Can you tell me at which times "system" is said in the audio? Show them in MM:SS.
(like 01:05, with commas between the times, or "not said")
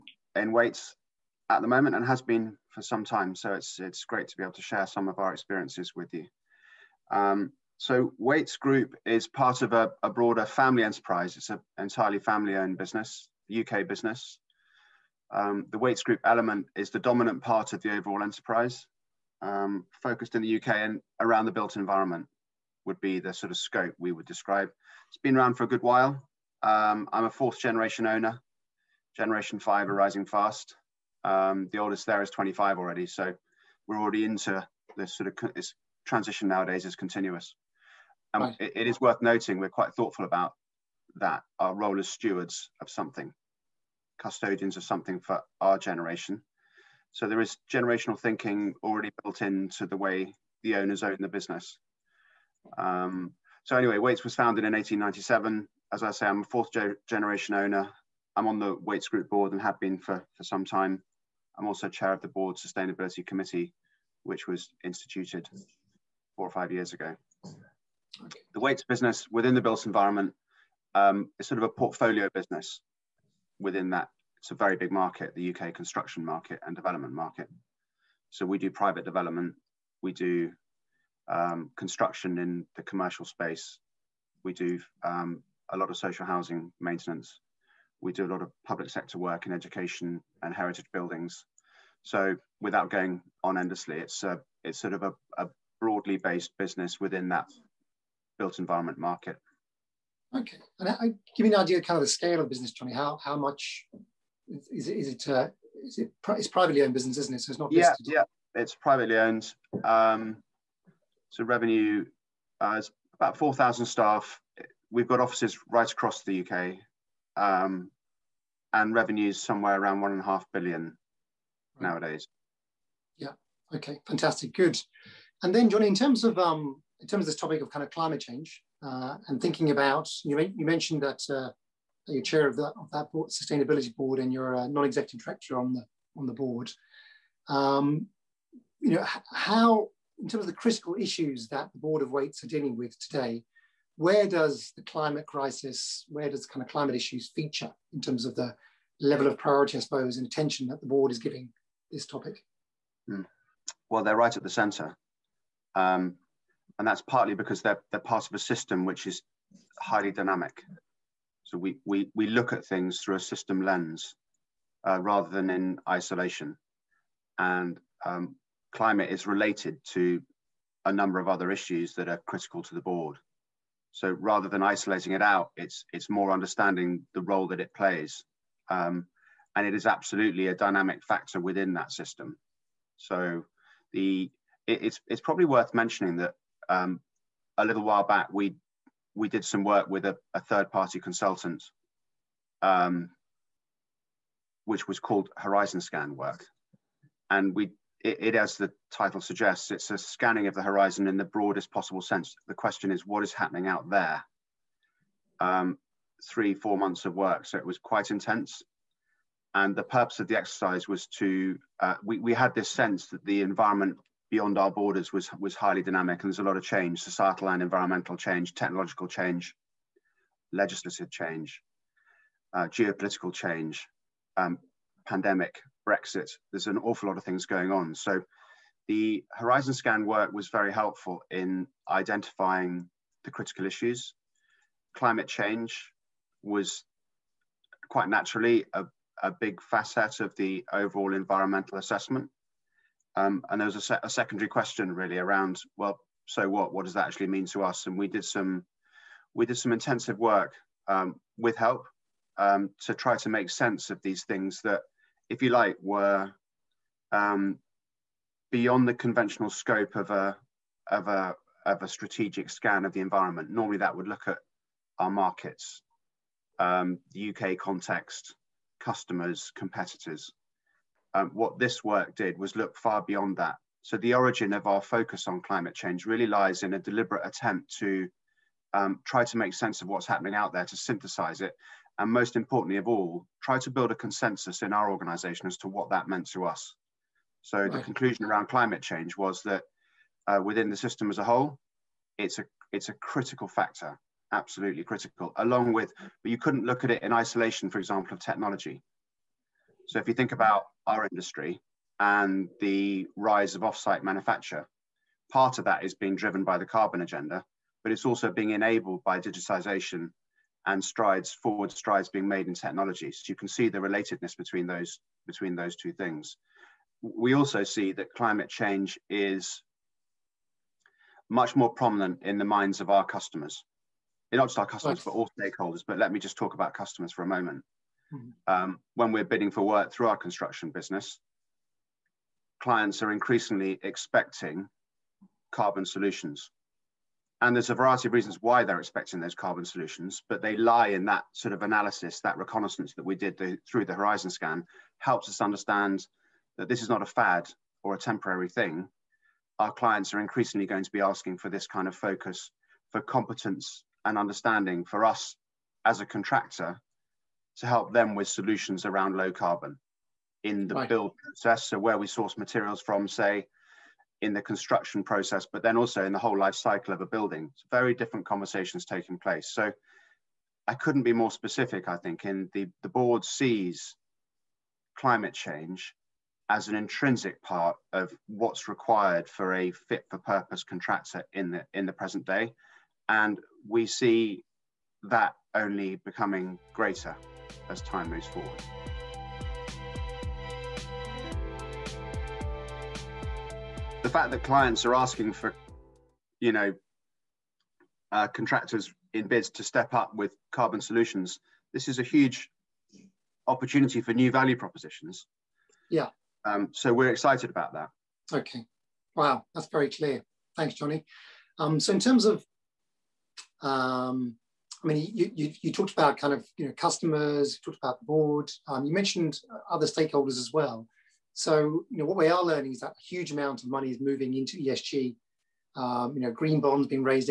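02:38, 02:43, 03:01, 04:50.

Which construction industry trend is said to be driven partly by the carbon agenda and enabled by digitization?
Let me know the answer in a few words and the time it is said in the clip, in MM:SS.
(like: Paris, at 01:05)
offsite manufacture, at 05:03.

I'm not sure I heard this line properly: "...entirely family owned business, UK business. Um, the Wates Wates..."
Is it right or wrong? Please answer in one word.
wrong.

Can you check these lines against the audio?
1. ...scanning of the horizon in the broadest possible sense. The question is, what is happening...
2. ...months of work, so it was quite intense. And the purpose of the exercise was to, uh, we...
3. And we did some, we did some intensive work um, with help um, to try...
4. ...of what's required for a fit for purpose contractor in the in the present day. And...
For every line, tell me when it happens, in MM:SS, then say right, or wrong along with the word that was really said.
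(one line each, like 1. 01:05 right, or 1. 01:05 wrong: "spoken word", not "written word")
1. 03:19 right
2. 03:26 right
3. 04:07 right
4. 06:17 right.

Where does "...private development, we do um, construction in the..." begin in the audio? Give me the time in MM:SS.
01:18.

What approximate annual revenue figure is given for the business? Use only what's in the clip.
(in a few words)
1.5 billion.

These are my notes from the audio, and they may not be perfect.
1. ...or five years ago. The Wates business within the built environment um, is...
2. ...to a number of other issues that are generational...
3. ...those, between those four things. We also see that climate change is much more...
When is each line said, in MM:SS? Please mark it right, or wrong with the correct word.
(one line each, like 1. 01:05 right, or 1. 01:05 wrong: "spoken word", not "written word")
1. 01:06 right
2. 02:49 wrong: "critical", not "generational"
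3. 05:14 wrong: "two", not "four".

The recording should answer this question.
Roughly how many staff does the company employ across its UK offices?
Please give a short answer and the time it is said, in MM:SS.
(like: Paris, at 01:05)
4,000, at 01:53.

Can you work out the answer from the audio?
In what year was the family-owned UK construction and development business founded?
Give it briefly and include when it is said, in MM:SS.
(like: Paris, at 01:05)
1897, at 00:54.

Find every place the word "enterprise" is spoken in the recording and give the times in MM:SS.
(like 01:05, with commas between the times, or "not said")
00:10, 00:18.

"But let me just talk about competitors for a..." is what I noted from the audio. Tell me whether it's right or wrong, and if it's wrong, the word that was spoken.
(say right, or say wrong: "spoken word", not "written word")
wrong: "customers", not "competitors".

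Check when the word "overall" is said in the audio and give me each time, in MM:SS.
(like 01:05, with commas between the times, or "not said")
00:17, 04:00.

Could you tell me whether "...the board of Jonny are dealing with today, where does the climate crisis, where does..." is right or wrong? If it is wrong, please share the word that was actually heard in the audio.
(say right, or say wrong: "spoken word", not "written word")
wrong: "Wates", not "Jonny".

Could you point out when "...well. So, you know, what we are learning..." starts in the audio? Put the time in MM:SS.
07:00.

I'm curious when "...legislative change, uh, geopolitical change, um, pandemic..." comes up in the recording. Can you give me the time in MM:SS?
03:40.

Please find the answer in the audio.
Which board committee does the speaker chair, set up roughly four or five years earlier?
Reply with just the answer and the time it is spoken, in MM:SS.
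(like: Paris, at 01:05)
sustainability committee, at 01:02.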